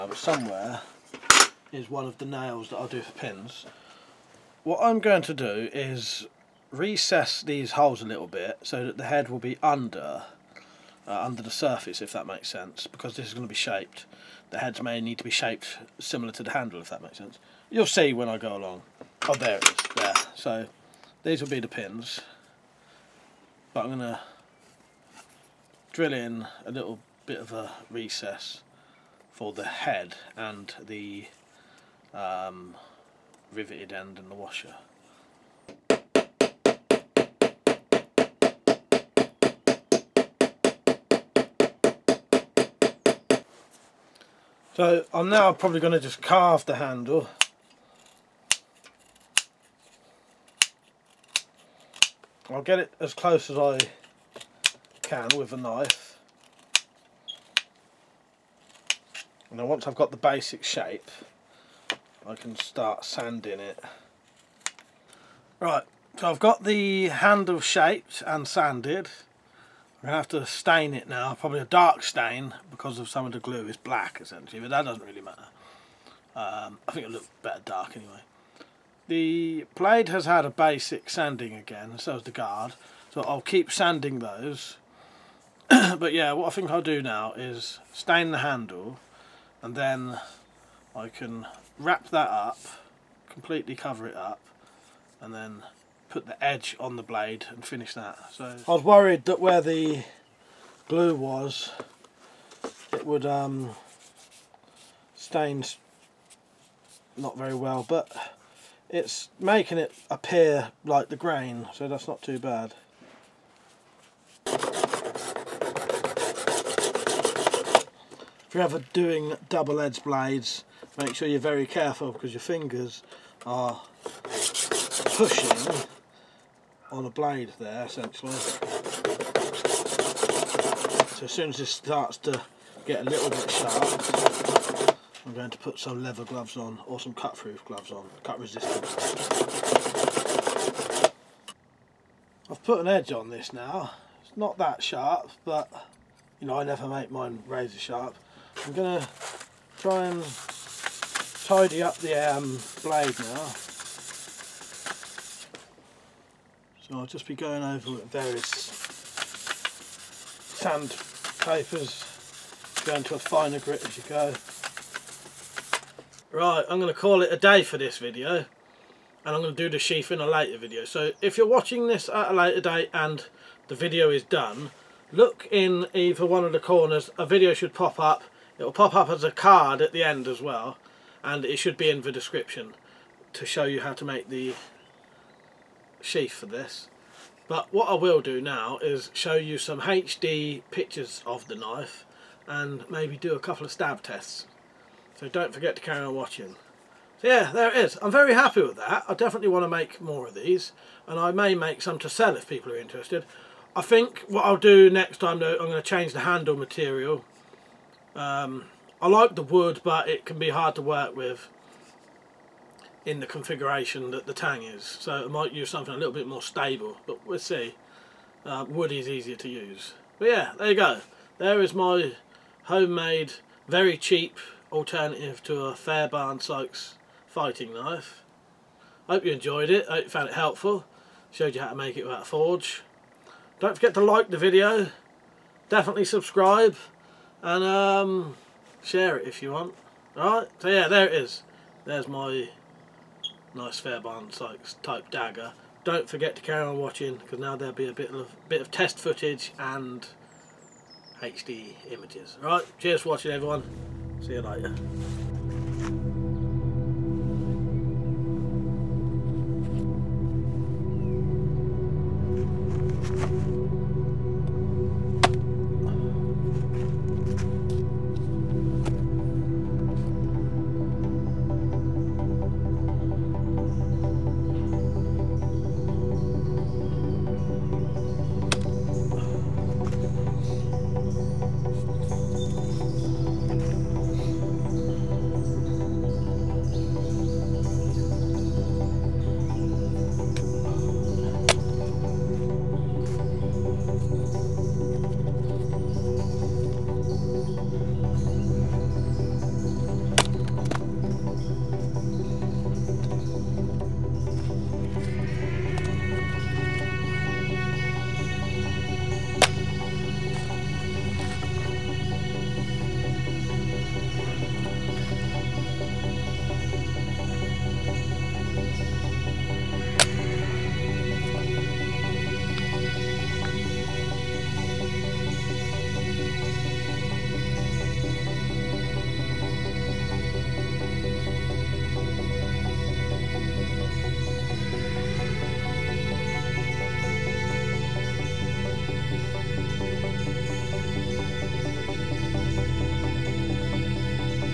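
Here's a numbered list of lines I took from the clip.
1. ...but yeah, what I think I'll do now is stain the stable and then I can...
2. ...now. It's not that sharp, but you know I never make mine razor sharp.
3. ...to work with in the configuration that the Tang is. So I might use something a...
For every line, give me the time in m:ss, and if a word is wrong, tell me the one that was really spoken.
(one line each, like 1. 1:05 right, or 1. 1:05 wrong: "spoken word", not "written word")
1. 1:25 wrong: "handle", not "stable"
2. 2:23 right
3. 3:30 right.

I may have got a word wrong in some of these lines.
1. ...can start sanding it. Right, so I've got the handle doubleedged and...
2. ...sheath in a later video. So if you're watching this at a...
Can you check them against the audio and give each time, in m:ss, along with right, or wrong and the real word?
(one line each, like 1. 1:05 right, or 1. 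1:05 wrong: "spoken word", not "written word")
1. 1:02 wrong: "shaped", not "doubleedged"
2. 2:49 right.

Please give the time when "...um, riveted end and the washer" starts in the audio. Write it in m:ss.
0:32.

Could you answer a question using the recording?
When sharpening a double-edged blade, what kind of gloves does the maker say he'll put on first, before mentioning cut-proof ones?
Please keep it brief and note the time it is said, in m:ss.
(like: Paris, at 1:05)
leather gloves, at 2:16.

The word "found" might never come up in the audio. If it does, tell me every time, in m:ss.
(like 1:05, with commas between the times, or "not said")
3:50.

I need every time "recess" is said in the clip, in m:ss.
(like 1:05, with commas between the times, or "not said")
0:06, 0:27.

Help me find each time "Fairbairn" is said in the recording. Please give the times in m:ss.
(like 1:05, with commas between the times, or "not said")
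3:45, 4:03.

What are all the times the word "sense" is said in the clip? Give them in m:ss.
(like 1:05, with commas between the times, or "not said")
0:12, 0:17.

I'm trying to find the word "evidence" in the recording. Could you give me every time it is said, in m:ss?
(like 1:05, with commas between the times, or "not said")
not said.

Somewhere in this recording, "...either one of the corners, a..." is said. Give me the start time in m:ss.
2:55.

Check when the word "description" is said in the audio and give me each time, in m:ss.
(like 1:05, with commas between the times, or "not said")
3:02.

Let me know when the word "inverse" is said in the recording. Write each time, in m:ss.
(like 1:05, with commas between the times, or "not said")
not said.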